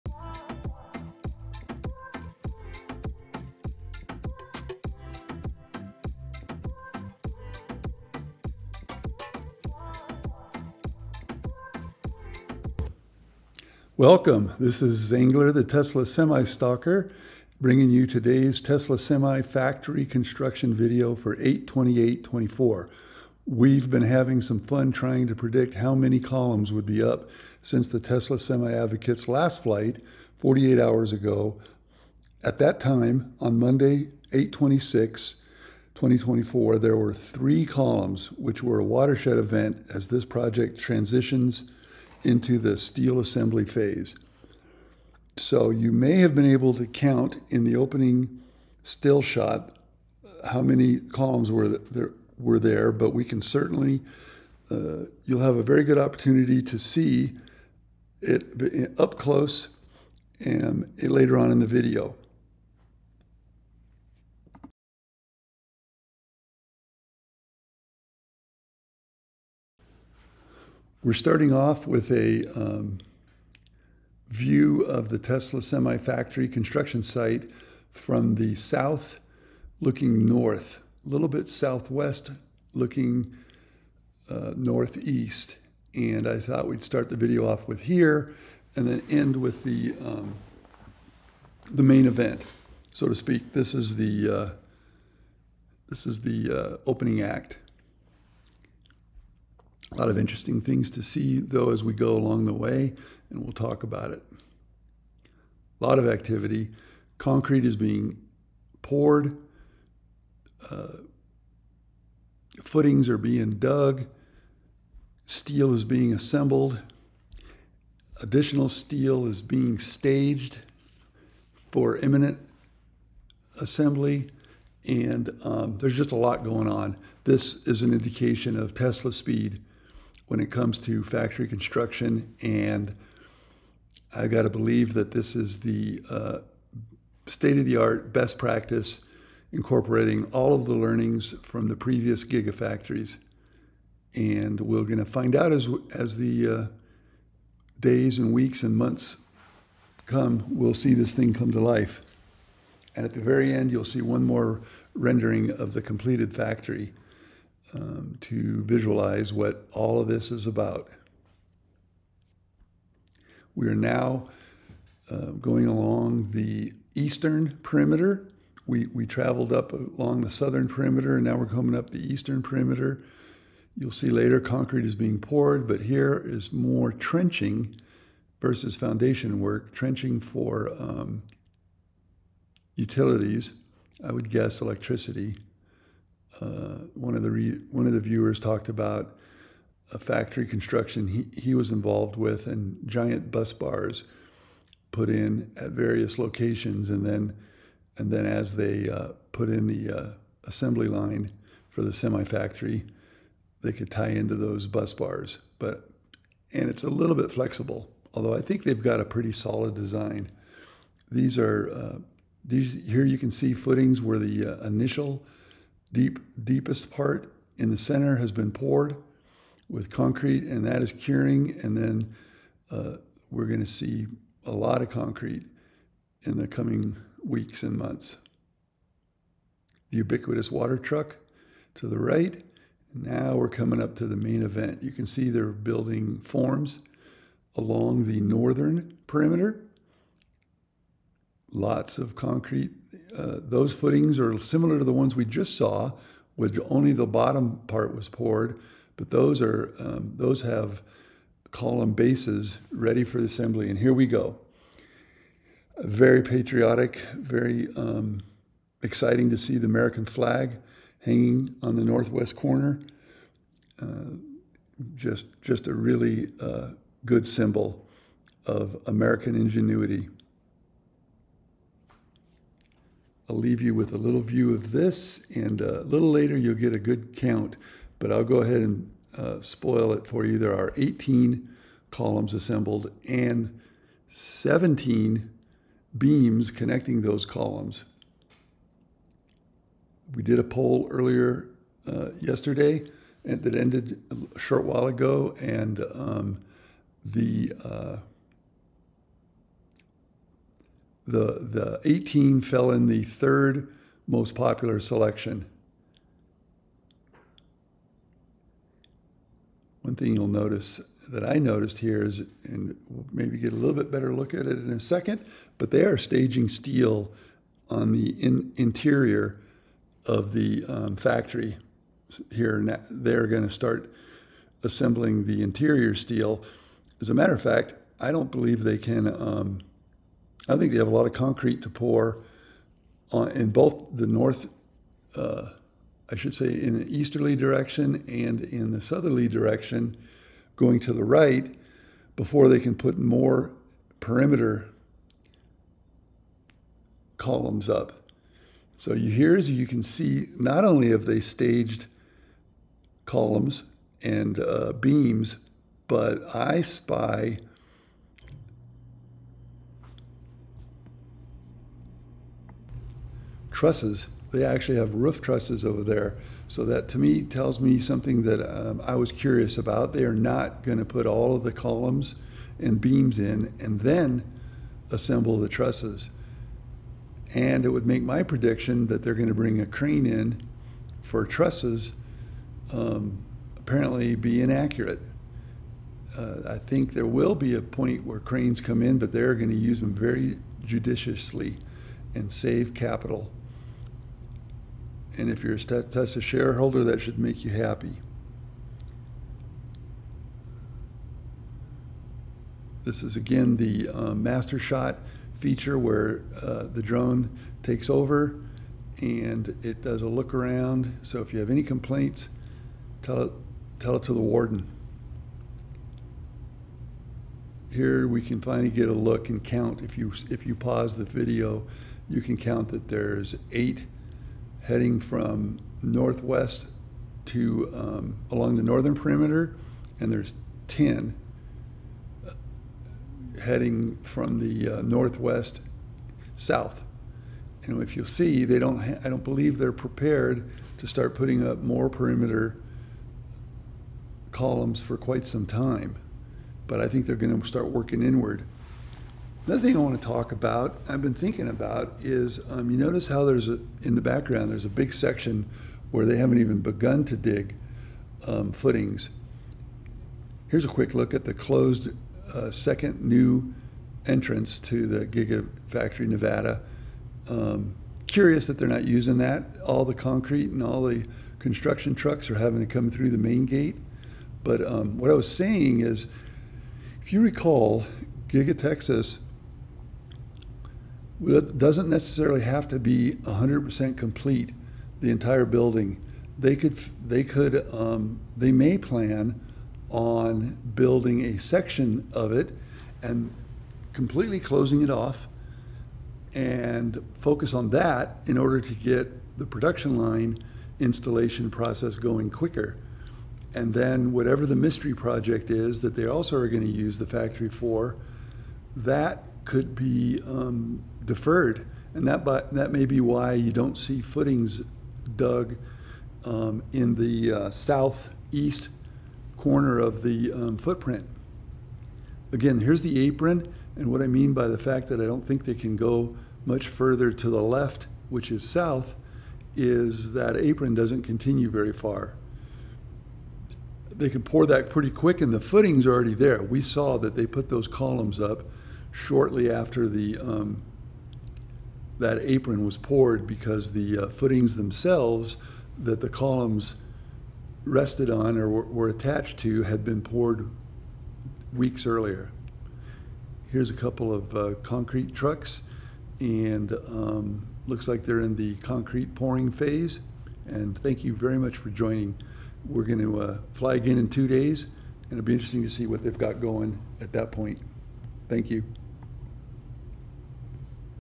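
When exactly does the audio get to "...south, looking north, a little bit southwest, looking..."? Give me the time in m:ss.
1:18.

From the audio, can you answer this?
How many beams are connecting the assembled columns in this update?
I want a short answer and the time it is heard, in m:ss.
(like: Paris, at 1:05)
17, at 4:44.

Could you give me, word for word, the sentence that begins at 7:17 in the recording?
And if you'll see, they don't.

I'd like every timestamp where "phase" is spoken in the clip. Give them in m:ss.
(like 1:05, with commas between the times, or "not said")
0:43, 9:19.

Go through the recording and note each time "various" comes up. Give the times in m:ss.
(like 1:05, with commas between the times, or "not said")
3:15.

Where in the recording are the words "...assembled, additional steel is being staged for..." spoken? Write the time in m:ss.
1:56.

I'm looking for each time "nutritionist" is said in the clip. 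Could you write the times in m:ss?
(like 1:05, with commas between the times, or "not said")
not said.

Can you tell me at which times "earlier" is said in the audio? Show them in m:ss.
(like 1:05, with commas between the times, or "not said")
4:50, 9:11.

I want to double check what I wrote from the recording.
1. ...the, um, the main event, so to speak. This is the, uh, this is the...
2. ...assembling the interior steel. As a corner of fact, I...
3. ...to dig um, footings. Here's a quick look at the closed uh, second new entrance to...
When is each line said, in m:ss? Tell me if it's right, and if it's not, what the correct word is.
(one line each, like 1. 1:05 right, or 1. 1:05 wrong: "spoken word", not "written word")
1. 1:29 right
2. 5:24 wrong: "matter", not "corner"
3. 7:37 right.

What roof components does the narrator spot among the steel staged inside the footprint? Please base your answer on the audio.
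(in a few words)
Roof trusses.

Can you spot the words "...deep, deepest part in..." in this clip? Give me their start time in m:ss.
3:35.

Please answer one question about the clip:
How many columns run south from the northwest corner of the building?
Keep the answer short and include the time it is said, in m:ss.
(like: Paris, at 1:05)
10, at 7:10.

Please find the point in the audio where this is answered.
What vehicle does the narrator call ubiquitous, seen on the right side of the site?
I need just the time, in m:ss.
3:50.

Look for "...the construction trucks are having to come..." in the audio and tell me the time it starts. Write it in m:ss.
7:50.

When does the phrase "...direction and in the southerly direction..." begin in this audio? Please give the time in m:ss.
5:37.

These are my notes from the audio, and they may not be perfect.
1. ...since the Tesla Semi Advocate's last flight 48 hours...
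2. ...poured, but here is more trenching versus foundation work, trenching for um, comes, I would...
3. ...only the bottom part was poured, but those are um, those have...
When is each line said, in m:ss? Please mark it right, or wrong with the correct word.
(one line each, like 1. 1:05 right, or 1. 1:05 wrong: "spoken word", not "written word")
1. 0:27 right
2. 2:55 wrong: "utilities", not "comes"
3. 4:06 right.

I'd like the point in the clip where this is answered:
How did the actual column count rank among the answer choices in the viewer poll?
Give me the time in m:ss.
5:03.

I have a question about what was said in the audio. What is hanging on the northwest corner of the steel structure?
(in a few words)
American flag.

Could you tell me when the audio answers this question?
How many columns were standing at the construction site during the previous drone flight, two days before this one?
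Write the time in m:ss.
0:37.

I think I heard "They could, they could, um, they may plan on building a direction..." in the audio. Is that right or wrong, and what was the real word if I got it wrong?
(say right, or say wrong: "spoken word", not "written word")
wrong: "section", not "direction".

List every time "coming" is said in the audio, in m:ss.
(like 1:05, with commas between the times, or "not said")
2:51, 3:46, 3:53.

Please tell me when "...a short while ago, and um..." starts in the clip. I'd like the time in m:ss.
4:54.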